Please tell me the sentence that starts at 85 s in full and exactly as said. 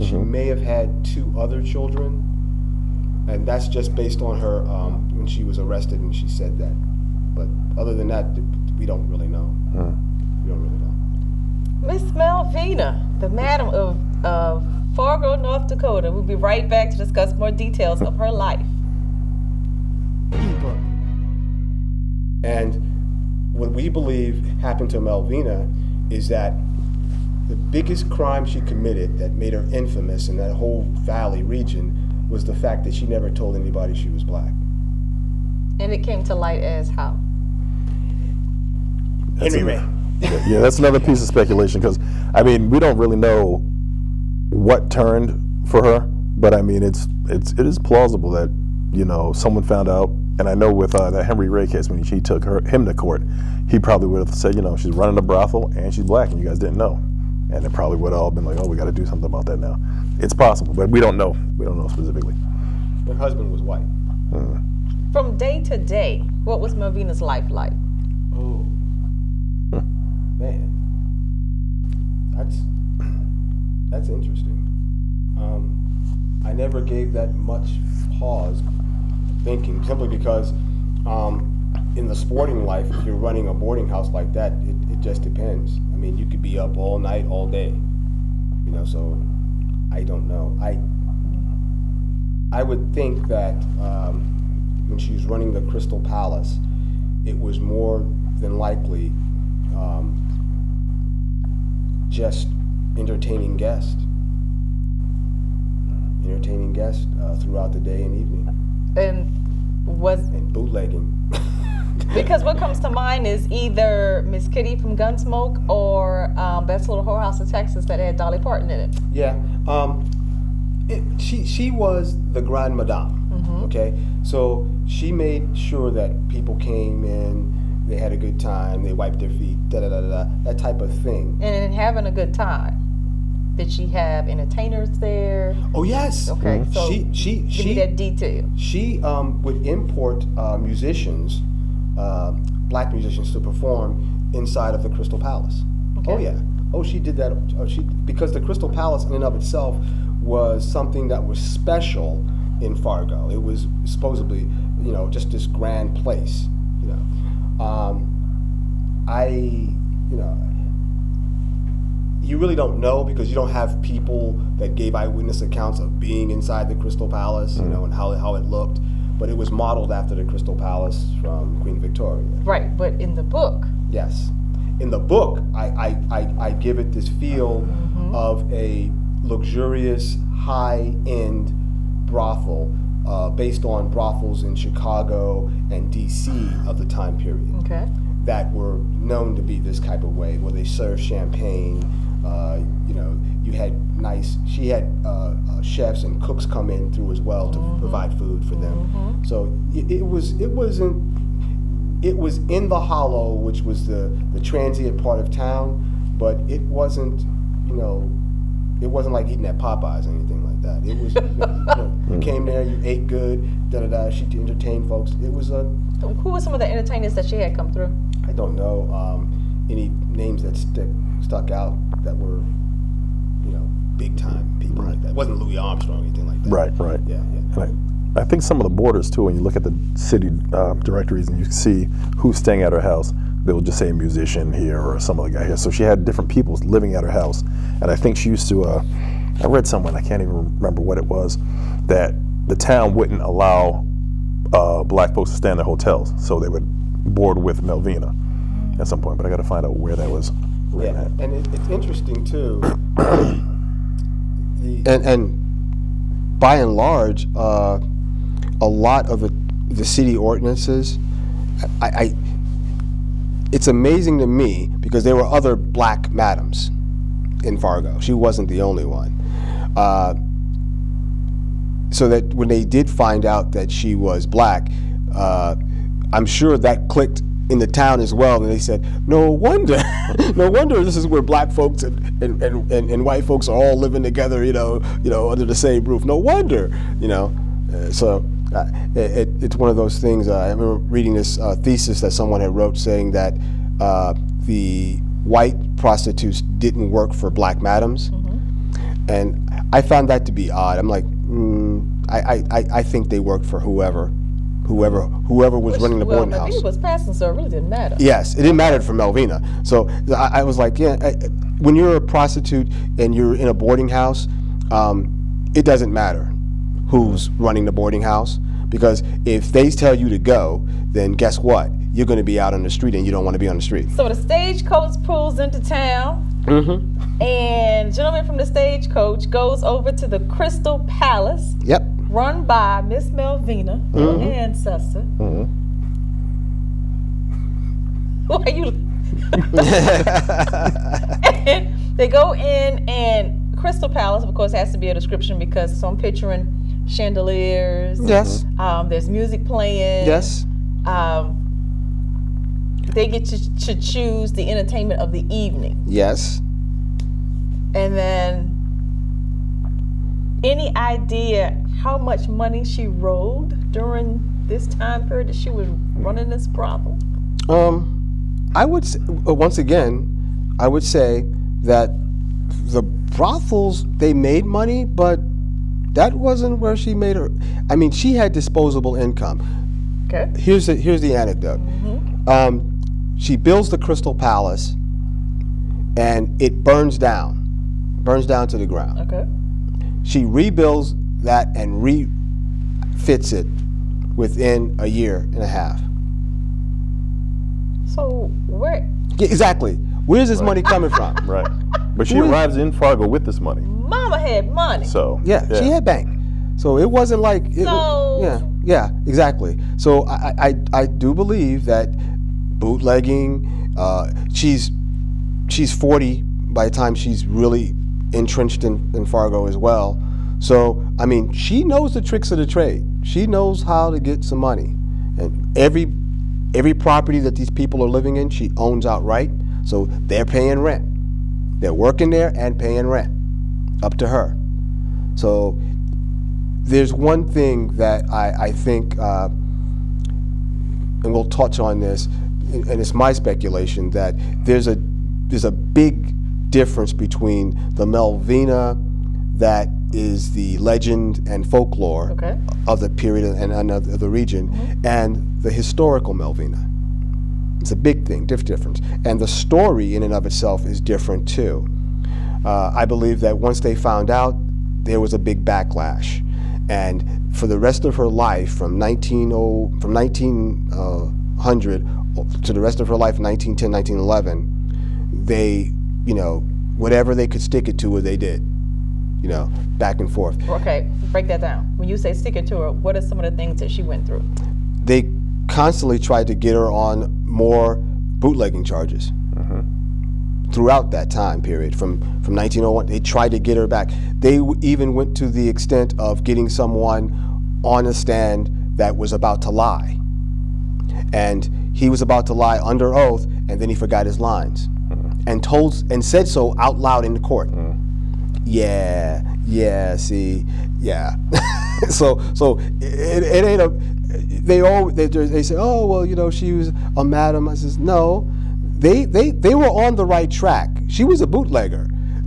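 I mean, you could be up all night, all day, you know.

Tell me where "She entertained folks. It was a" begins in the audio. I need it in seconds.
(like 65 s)
214 s.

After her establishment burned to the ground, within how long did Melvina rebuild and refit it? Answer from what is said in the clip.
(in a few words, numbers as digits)
a year and a half.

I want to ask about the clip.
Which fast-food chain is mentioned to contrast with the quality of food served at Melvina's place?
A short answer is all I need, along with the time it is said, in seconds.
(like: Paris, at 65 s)
Popeyes, at 209 s.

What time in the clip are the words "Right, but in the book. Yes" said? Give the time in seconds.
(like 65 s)
172 s.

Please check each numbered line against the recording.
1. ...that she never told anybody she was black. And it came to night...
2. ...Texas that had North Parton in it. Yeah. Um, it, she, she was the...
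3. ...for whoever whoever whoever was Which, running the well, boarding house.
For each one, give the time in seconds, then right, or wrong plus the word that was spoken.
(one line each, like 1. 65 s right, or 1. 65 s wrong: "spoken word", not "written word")
1. 32 s wrong: "light", not "night"
2. 117 s wrong: "Dolly", not "North"
3. 303 s right.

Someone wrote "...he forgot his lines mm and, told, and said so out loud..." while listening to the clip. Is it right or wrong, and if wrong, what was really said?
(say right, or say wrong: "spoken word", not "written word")
right.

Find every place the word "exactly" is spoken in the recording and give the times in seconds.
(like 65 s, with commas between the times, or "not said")
399 s, 409 s.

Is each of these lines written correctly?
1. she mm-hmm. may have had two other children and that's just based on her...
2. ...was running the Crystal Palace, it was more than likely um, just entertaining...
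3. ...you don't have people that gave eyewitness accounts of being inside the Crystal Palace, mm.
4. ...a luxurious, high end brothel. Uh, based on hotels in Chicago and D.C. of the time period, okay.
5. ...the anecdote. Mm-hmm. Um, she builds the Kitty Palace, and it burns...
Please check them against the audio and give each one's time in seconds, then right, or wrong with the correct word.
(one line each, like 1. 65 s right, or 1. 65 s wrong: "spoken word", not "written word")
1. 0 s right
2. 95 s right
3. 163 s right
4. 178 s wrong: "brothels", not "hotels"
5. 381 s wrong: "Crystal", not "Kitty".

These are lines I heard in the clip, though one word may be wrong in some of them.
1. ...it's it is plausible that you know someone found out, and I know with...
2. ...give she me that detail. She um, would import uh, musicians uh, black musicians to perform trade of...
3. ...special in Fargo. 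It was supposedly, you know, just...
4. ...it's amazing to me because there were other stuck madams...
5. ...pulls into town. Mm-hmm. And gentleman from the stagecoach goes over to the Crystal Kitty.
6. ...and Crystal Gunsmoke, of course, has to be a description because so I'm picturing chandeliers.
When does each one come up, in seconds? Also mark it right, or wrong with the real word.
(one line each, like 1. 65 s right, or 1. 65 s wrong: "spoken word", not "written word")
1. 47 s right
2. 137 s wrong: "inside", not "trade"
3. 151 s right
4. 263 s wrong: "black", not "stuck"
5. 325 s wrong: "Palace", not "Kitty"
6. 342 s wrong: "Palace", not "Gunsmoke".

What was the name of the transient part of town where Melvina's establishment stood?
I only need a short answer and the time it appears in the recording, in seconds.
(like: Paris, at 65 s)
the Hollow, at 202 s.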